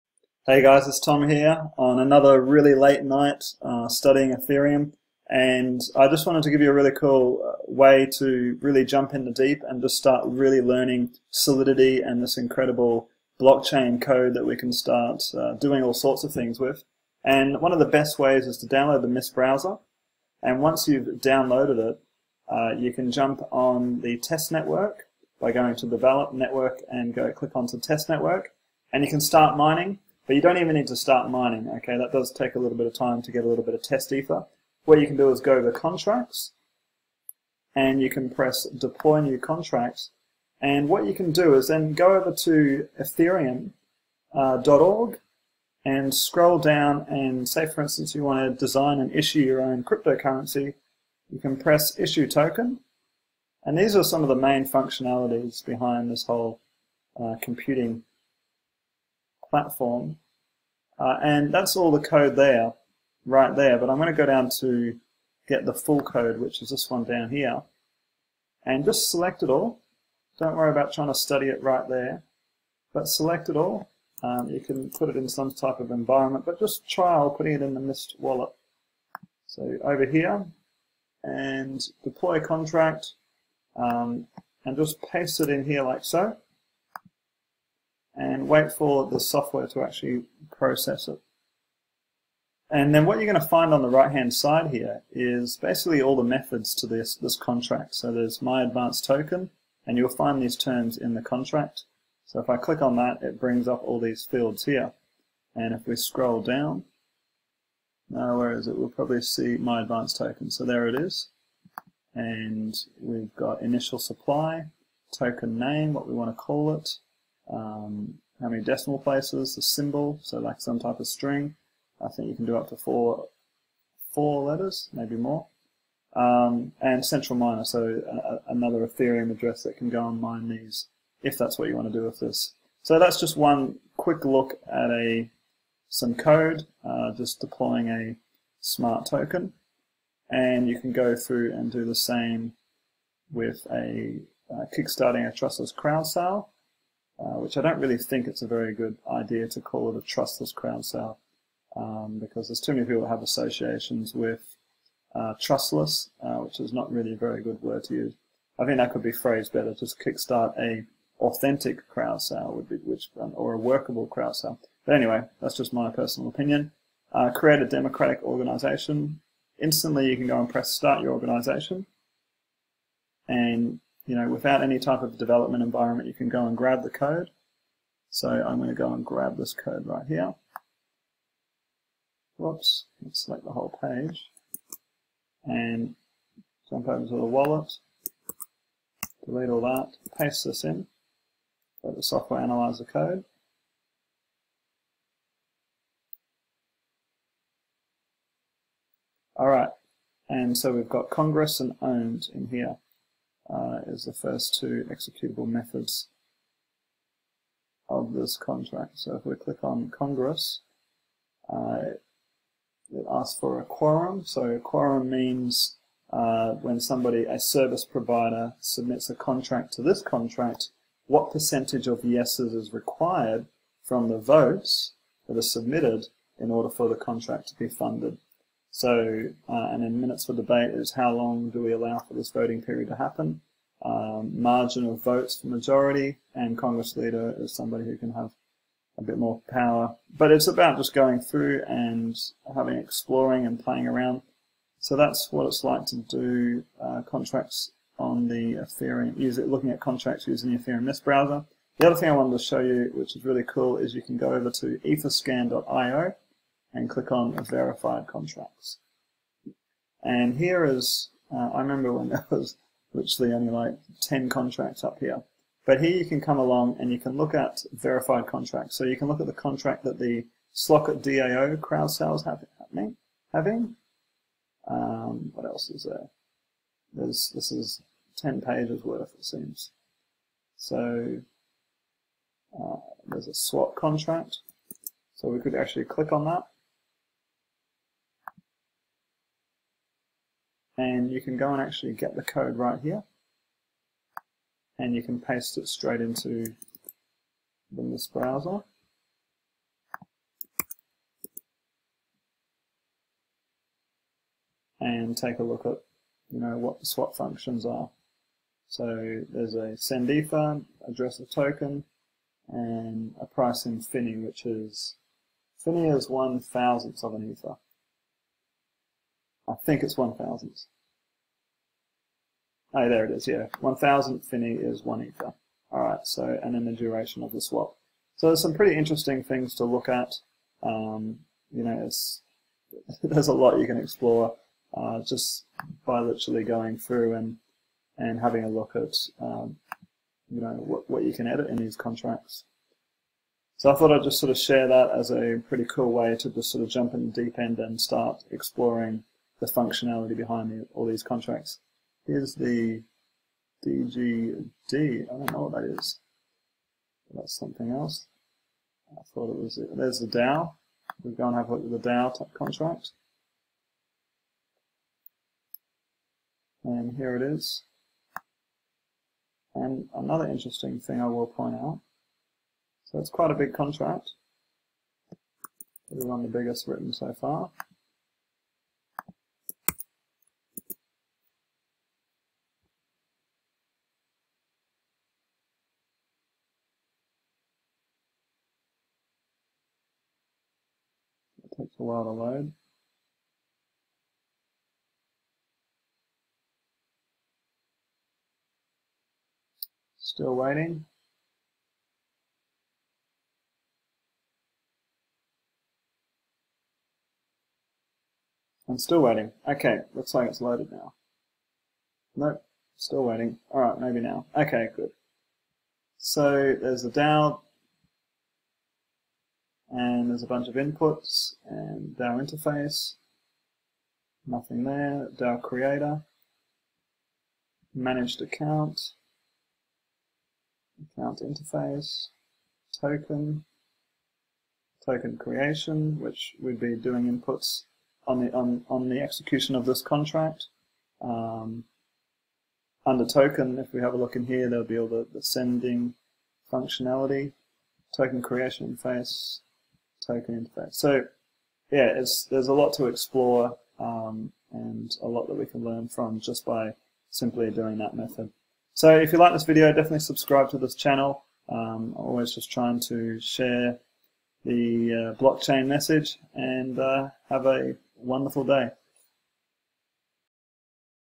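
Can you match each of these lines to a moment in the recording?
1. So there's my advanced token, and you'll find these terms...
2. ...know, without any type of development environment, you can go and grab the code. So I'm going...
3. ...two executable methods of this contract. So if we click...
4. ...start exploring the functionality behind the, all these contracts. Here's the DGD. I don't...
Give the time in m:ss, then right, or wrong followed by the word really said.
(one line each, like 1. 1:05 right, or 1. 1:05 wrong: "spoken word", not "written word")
1. 1:37 right
2. 2:54 right
3. 3:24 right
4. 5:47 right.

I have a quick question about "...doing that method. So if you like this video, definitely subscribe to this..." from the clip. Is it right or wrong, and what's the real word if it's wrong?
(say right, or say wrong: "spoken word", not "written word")
right.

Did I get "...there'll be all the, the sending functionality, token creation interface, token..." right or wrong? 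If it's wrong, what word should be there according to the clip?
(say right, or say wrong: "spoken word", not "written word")
right.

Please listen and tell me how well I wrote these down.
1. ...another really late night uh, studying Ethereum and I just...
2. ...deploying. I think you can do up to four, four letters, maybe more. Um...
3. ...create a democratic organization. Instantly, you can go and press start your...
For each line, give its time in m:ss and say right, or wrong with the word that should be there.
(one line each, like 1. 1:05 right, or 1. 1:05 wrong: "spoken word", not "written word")
1. 0:01 right
2. 2:01 wrong: "string", not "deploying"
3. 2:47 right.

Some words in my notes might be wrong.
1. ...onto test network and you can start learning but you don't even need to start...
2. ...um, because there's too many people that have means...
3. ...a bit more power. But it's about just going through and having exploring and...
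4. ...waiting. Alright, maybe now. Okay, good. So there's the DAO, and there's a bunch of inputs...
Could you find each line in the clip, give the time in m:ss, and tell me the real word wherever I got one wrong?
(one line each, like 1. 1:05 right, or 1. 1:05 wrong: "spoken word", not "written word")
1. 0:27 wrong: "mining", not "learning"
2. 2:31 wrong: "associations", not "means"
3. 3:58 right
4. 6:53 right.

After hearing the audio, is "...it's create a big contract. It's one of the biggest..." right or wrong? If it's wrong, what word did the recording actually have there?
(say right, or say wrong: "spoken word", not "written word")
wrong: "quite", not "create".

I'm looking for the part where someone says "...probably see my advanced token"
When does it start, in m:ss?
1:48.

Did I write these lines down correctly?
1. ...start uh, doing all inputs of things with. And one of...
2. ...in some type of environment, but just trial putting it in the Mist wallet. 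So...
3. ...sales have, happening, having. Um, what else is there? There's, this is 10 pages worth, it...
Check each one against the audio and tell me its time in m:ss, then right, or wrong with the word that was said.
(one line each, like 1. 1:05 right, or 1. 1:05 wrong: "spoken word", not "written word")
1. 0:14 wrong: "sorts", not "inputs"
2. 1:15 right
3. 4:31 right.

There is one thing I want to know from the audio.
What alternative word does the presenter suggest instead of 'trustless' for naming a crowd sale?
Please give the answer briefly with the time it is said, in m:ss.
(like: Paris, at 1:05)
authentic, at 2:41.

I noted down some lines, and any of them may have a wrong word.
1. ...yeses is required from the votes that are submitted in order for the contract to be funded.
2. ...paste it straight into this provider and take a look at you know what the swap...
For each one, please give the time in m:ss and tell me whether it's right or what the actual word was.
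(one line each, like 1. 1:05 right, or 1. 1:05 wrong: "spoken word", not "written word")
1. 3:42 right
2. 4:55 wrong: "browser", not "provider".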